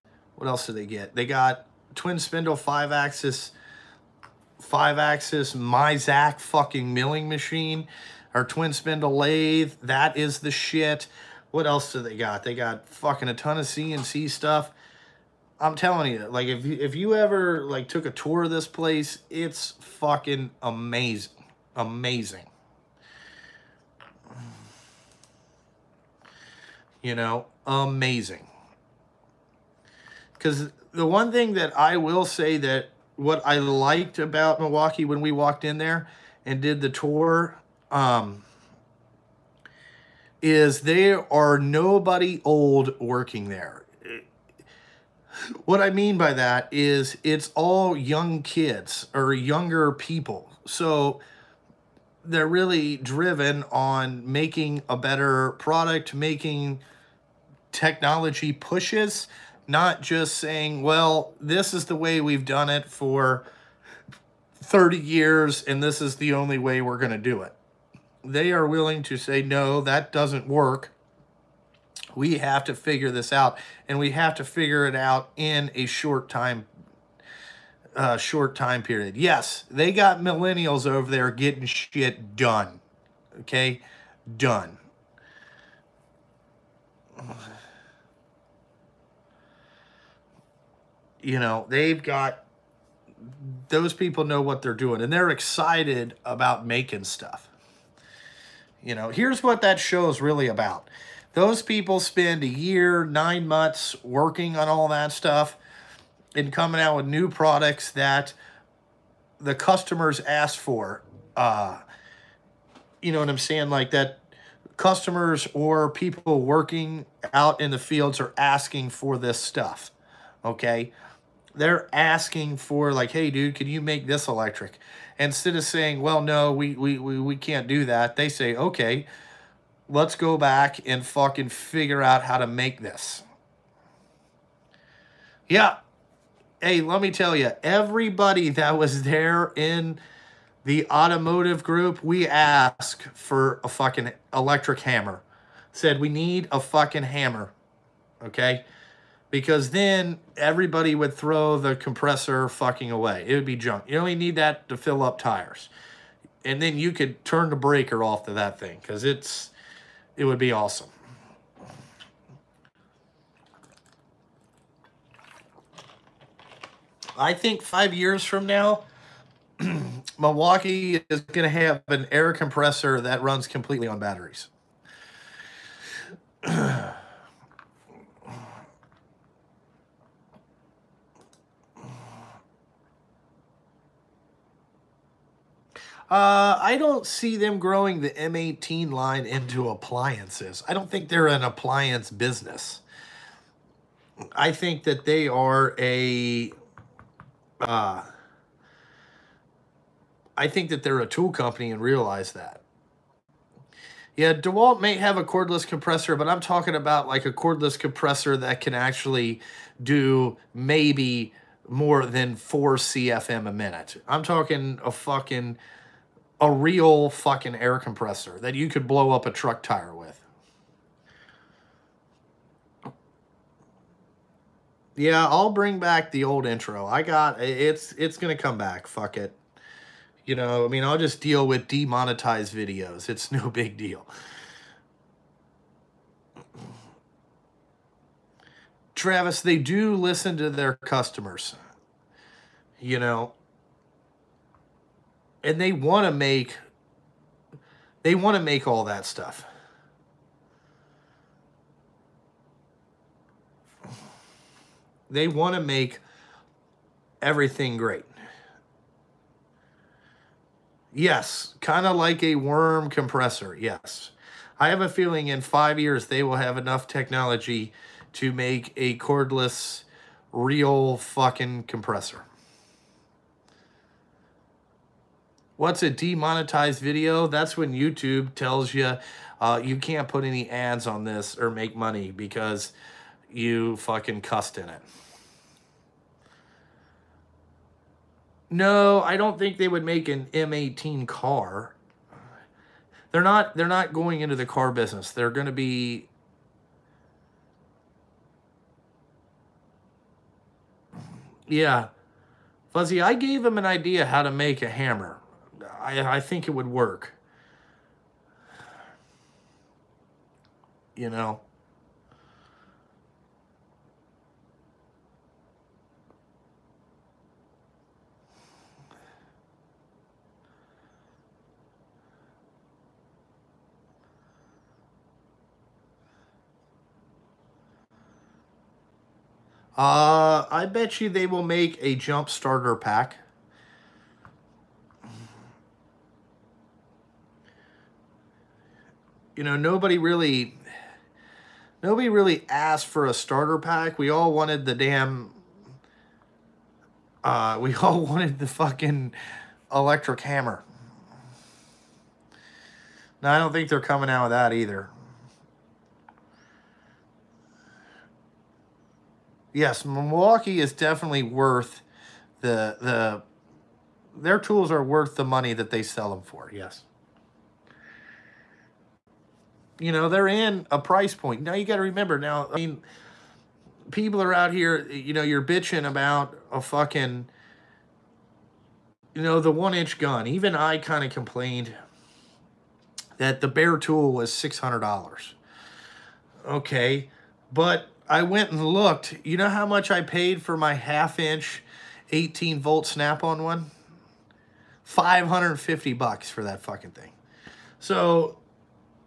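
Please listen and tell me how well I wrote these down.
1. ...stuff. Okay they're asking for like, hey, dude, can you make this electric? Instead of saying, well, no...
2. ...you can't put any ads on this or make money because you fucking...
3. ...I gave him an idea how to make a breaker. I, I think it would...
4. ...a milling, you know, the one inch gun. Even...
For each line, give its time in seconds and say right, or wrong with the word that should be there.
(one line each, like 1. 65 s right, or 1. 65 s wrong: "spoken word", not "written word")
1. 119 s right
2. 279 s right
3. 303 s wrong: "hammer", not "breaker"
4. 376 s wrong: "fucking", not "milling".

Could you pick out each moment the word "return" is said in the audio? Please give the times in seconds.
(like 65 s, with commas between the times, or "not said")
not said.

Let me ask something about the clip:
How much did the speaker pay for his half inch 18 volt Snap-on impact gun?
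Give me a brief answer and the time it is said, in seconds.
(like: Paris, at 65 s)
$550, at 394 s.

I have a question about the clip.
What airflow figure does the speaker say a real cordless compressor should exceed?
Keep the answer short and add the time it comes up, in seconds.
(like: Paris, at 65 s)
4 CFM, at 212 s.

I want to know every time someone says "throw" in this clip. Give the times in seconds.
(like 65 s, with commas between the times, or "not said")
151 s.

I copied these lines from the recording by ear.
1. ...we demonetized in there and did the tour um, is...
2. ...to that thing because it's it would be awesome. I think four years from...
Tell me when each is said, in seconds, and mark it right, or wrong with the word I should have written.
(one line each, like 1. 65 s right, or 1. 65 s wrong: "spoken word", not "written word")
1. 35 s wrong: "walked", not "demonetized"
2. 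158 s wrong: "five", not "four".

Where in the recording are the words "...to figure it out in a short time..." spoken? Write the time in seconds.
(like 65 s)
74 s.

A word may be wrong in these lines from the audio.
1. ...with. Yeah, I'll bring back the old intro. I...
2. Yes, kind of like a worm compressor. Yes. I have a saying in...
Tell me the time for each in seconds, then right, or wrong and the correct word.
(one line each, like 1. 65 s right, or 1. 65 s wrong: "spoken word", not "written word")
1. 219 s right
2. 260 s wrong: "feeling", not "saying".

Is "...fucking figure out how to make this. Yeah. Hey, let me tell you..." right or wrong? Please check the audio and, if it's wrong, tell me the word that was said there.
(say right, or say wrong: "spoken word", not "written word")
right.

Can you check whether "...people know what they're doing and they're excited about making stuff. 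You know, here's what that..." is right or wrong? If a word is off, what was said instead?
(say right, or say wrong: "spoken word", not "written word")
right.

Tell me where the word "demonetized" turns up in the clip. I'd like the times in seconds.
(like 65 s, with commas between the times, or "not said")
231 s, 275 s.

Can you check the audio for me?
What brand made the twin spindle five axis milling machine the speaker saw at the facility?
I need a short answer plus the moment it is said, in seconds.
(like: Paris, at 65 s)
Mazak, at 5 s.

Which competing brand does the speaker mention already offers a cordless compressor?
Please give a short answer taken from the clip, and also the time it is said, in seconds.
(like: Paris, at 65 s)
DeWalt, at 204 s.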